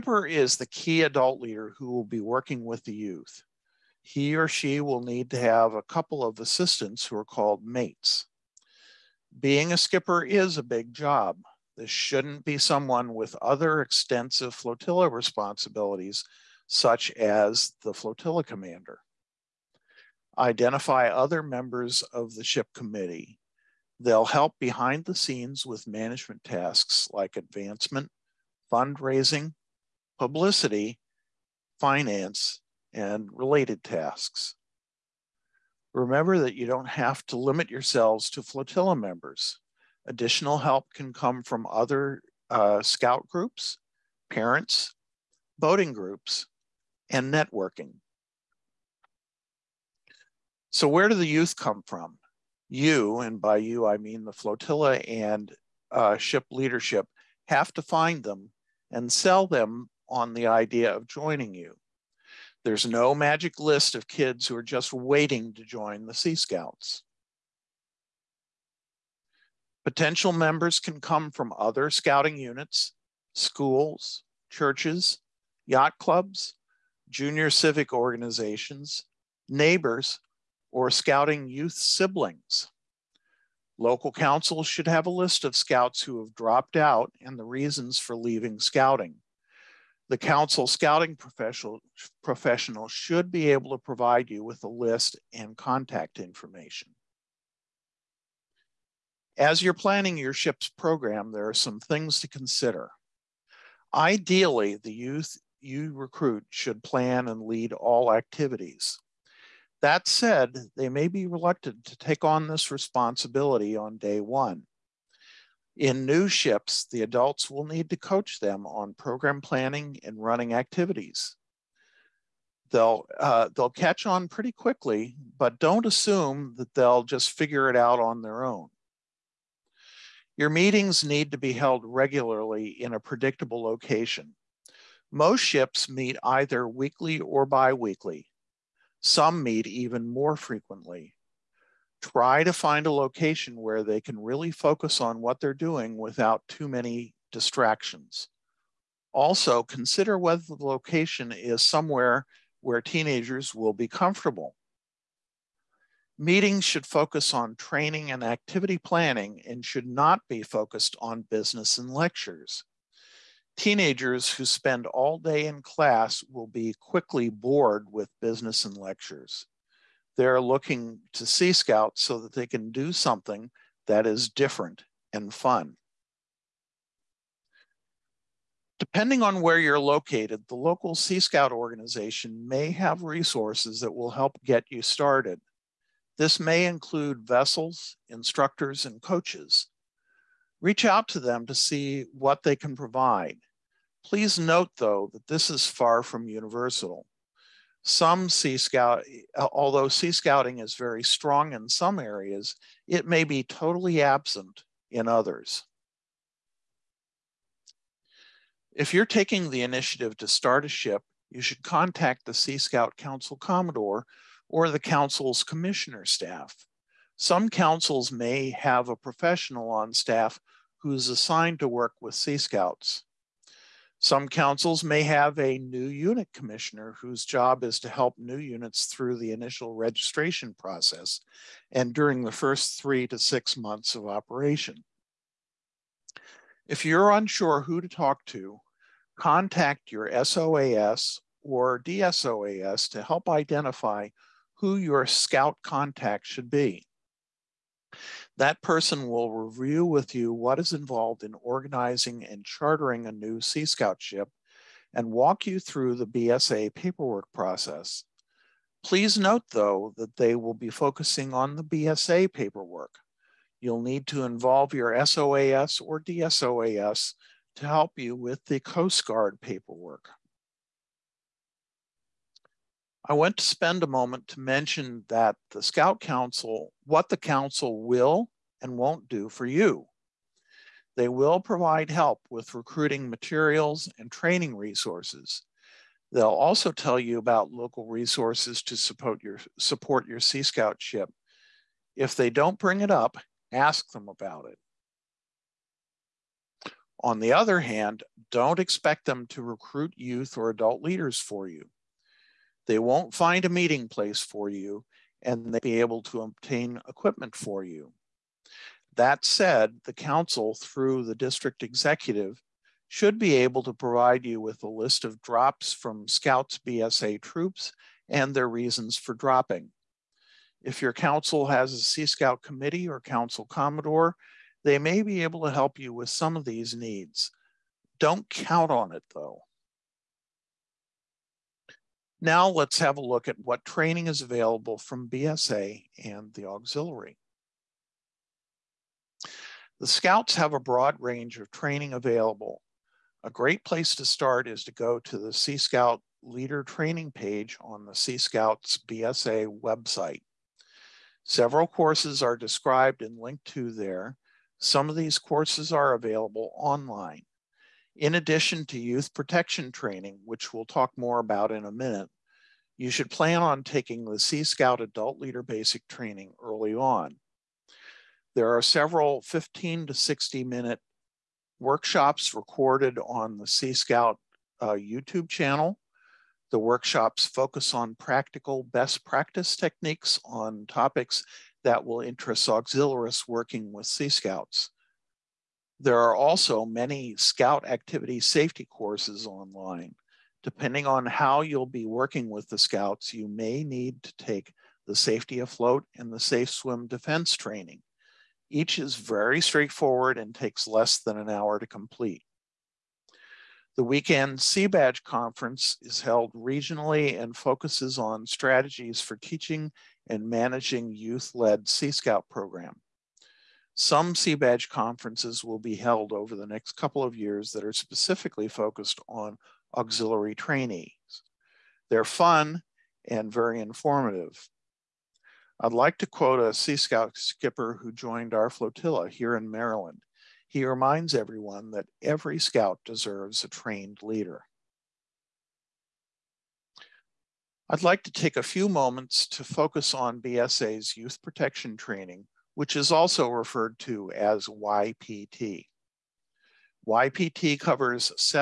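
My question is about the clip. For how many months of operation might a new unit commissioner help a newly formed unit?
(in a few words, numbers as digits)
3 to 6 months.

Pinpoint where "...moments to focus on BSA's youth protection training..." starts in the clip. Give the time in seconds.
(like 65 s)
438 s.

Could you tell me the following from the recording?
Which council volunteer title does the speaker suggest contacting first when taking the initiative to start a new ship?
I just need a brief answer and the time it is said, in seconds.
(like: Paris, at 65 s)
Sea Scout Council Commodore, at 212 s.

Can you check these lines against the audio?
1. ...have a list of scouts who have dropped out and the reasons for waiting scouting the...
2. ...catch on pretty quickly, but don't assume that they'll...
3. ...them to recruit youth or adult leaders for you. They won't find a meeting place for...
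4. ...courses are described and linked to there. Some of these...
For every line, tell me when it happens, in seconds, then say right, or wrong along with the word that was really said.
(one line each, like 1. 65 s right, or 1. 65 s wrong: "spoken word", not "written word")
1. 84 s wrong: "leaving", not "waiting"
2. 123 s right
3. 299 s right
4. 351 s right.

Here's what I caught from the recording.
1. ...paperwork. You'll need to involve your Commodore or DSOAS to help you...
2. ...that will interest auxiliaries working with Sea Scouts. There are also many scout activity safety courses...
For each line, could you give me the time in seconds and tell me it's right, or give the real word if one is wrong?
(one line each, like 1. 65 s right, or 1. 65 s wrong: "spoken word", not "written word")
1. 262 s wrong: "SOAS", not "Commodore"
2. 381 s right.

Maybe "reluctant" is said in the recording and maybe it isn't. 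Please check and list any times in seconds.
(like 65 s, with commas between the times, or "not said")
111 s.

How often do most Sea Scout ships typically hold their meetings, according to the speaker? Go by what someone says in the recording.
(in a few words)
Weekly or biweekly.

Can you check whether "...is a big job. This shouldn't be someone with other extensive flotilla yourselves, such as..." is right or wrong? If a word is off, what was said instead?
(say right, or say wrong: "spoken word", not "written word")
wrong: "responsibilities", not "yourselves".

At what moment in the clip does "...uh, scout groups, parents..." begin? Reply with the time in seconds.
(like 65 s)
42 s.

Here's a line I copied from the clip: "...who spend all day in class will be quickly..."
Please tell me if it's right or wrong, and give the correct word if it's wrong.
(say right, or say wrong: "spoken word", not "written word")
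right.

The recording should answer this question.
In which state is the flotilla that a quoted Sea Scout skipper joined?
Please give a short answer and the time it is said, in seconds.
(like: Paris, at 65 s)
Maryland, at 429 s.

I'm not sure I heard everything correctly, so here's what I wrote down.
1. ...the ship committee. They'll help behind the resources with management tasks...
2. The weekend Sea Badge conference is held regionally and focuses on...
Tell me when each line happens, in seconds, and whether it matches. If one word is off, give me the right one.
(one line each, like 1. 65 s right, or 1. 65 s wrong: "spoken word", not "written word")
1. 22 s wrong: "scenes", not "resources"
2. 403 s right.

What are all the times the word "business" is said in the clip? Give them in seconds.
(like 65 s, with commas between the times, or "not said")
161 s, 168 s.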